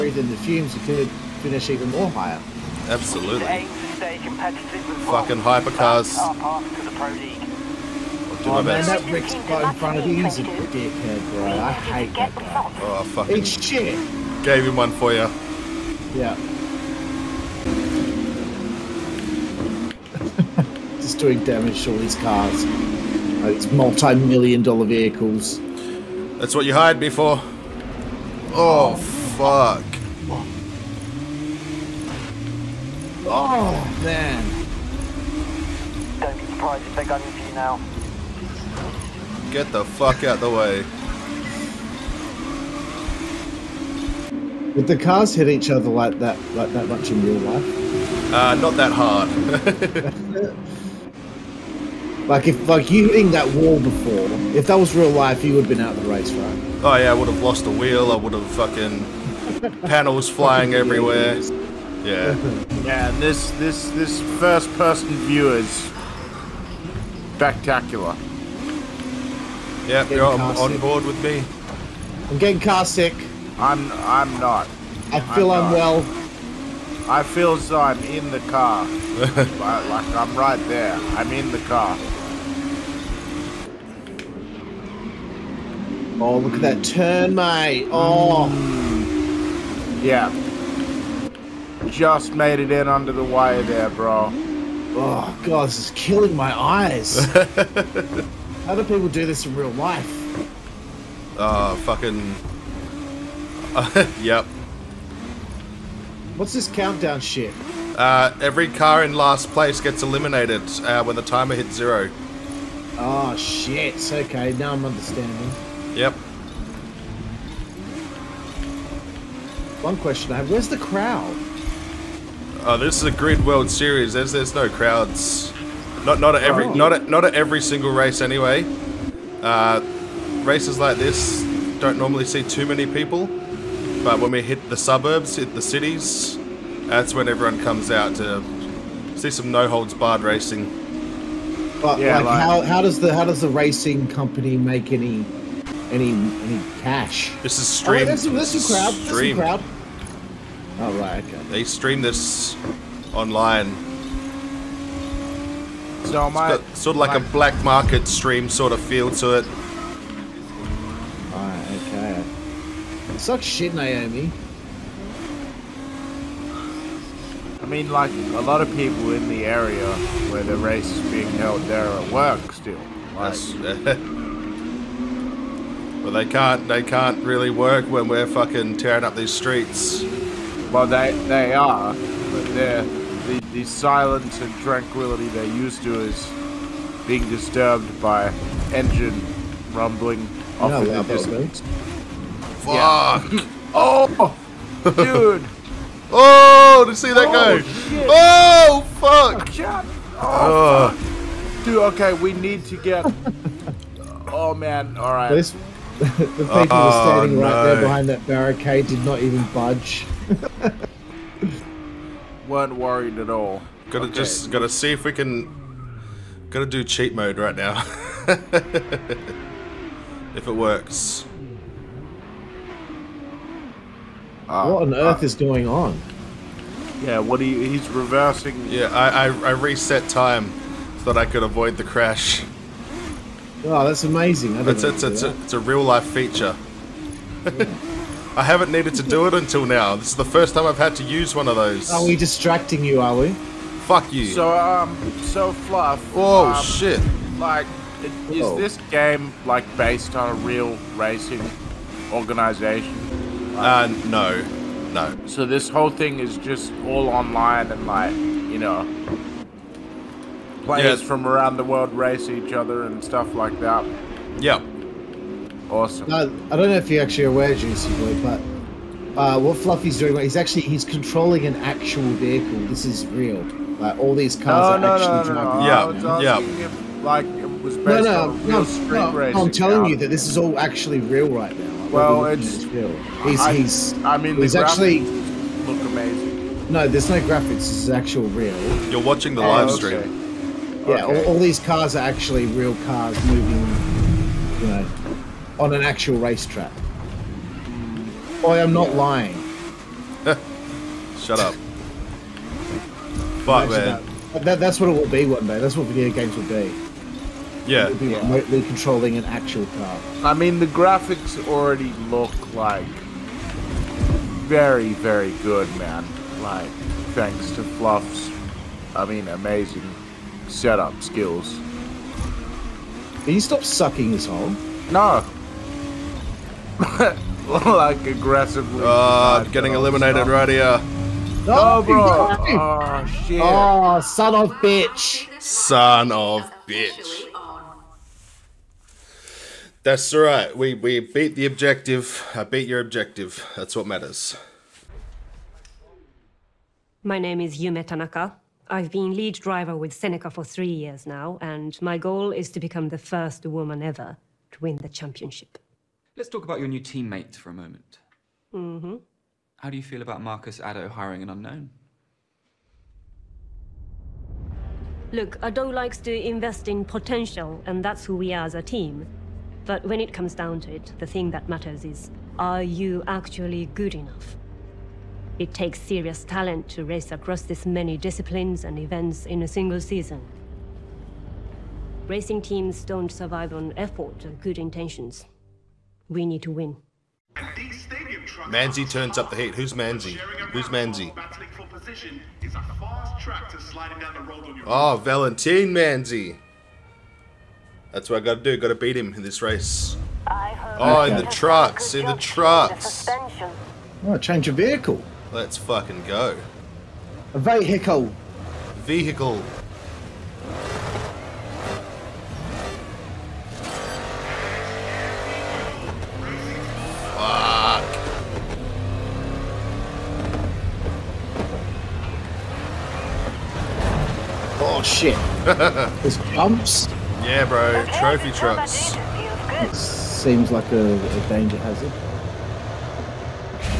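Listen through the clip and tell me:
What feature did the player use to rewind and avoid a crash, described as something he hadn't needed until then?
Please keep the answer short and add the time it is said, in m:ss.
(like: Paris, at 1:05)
Reset time, at 3:49.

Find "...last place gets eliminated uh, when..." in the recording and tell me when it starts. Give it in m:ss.
1:49.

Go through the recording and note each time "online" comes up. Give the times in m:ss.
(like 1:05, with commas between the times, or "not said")
2:33, 4:17.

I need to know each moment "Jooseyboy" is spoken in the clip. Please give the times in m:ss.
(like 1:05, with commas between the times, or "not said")
4:27.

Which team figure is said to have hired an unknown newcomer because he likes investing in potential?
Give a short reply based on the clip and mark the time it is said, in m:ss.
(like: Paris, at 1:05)
Marcus Addo, at 6:00.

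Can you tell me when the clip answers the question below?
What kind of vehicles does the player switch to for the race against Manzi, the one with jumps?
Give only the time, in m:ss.
7:07.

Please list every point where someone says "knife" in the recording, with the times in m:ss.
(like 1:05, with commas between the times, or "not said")
not said.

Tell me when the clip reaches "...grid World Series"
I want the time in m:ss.
2:03.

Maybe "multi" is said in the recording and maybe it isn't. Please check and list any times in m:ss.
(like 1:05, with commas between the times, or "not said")
0:23.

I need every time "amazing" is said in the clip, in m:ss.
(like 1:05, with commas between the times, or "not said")
3:54, 4:45, 5:19.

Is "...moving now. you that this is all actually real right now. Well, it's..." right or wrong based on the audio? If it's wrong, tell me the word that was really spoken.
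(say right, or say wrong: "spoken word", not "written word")
wrong: "telling", not "moving".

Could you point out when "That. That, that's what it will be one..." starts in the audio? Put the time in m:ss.
5:04.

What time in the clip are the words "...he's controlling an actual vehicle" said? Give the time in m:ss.
4:30.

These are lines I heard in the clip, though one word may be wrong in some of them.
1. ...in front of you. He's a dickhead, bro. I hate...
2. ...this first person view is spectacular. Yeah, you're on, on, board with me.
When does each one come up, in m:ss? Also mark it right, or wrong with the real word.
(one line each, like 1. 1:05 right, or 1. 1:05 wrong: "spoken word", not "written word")
1. 0:09 right
2. 1:03 right.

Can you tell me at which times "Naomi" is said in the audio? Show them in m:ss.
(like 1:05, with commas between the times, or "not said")
2:43.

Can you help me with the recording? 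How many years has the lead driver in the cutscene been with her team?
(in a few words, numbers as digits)
3.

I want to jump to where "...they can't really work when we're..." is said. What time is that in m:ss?
2:56.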